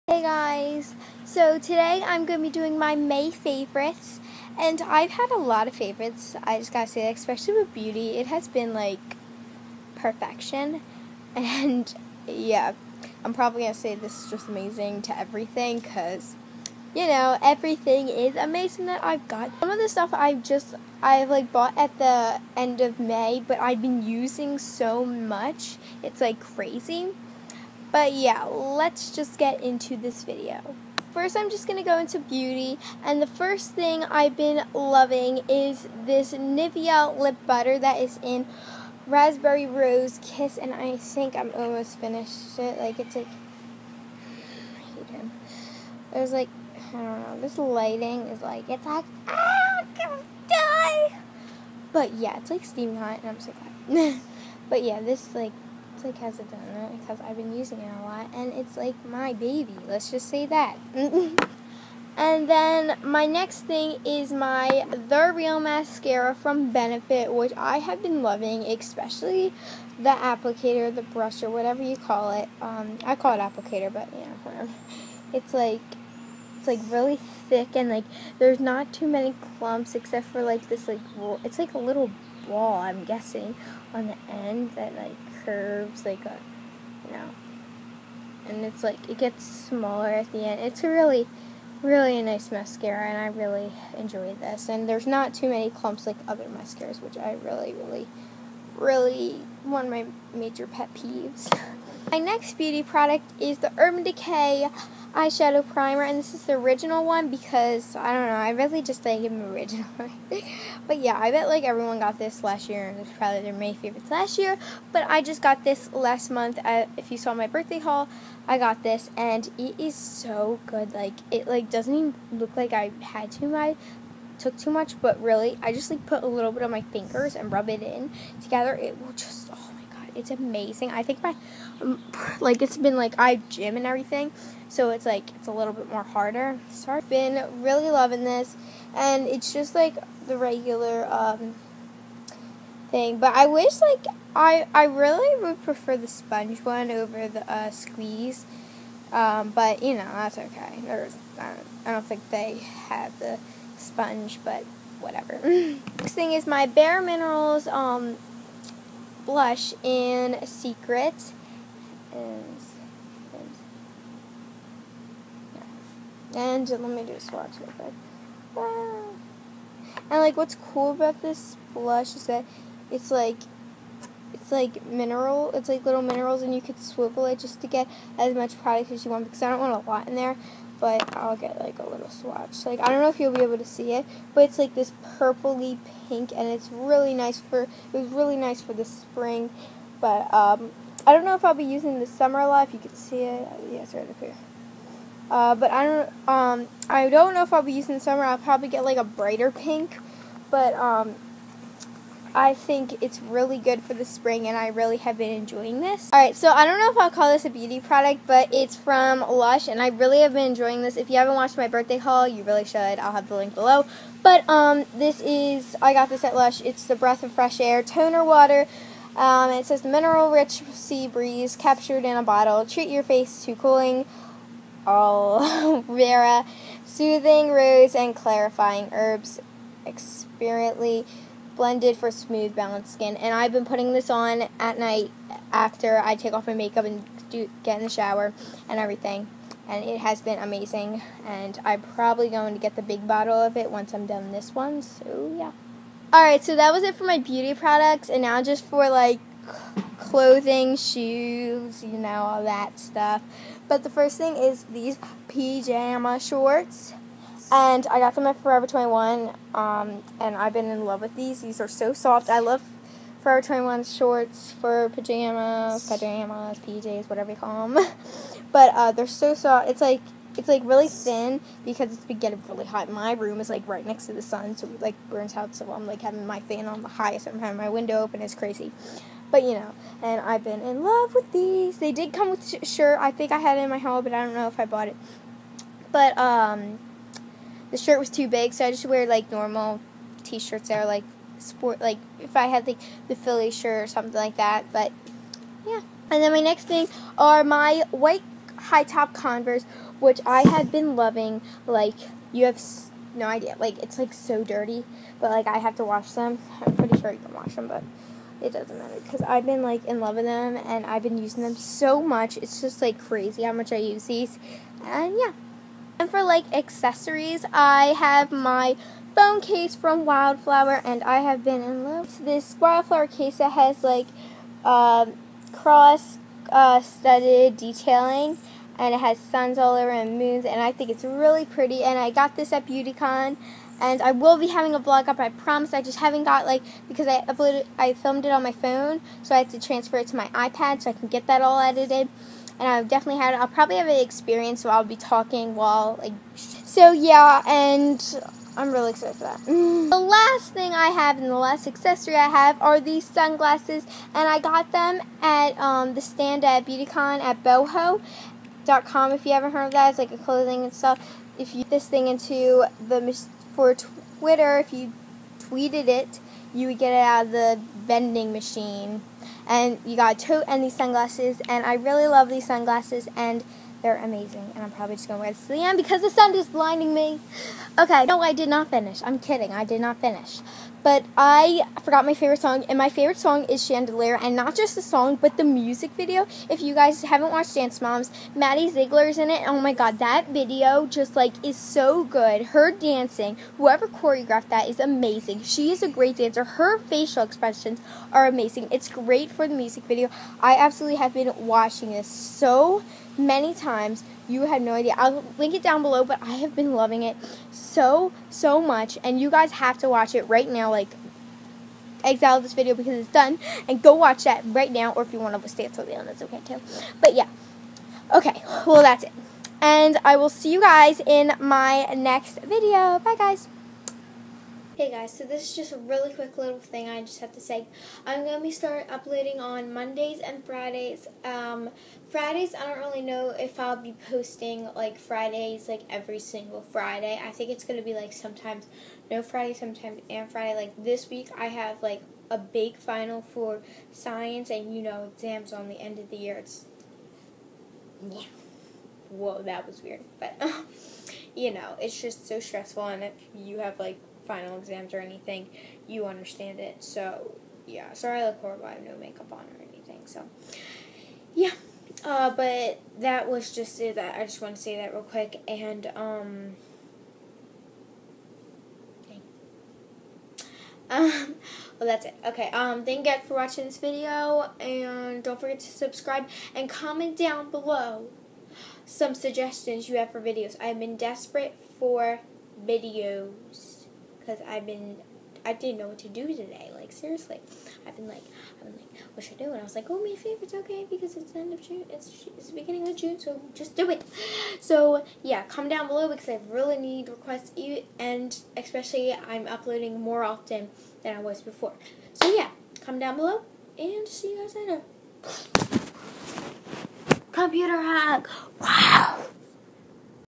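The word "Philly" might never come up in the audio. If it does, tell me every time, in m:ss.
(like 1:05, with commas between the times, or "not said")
4:53.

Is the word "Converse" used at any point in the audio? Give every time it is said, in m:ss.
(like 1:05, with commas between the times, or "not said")
4:59.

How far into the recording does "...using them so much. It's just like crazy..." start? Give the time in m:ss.
5:11.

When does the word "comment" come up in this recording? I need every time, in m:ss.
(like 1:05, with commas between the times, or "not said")
7:56, 8:15, 8:22.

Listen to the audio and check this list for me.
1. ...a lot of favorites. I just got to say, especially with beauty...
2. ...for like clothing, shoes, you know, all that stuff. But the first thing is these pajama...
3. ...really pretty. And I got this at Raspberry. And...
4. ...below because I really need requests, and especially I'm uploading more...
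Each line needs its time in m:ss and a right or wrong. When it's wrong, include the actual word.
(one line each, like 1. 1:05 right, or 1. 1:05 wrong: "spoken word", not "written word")
1. 0:05 right
2. 4:08 right
3. 5:31 wrong: "BeautyCon", not "Raspberry"
4. 8:15 right.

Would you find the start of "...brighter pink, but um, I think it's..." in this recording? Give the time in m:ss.
3:19.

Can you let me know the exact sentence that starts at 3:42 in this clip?
Treat your face to cooling aloe vera, soothing rose, and clarifying herbs.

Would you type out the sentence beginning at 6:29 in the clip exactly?
Oh my god, that video just like is so good.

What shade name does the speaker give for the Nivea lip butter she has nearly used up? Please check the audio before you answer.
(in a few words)
Raspberry Rose Kiss.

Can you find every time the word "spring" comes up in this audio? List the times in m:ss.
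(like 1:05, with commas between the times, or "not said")
3:08, 3:24.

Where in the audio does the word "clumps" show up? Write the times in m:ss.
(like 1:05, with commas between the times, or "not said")
1:19, 1:35.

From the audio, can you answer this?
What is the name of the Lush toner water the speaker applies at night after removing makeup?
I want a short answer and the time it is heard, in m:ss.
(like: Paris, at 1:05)
Breath of Fresh Air, at 3:36.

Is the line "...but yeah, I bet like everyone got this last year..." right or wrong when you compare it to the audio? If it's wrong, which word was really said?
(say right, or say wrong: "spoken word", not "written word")
right.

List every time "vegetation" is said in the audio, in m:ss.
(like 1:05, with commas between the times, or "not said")
not said.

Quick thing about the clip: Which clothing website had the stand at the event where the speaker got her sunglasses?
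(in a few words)
boohoo.com.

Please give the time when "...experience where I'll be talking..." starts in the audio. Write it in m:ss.
5:43.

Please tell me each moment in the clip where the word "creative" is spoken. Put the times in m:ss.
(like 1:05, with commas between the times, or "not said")
not said.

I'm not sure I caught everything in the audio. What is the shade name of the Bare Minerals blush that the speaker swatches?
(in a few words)
Secret.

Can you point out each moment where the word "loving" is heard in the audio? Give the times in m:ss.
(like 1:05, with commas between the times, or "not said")
0:34, 1:08, 2:17, 5:00, 6:46.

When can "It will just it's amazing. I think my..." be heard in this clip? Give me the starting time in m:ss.
2:08.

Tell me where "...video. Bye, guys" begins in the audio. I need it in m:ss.
7:02.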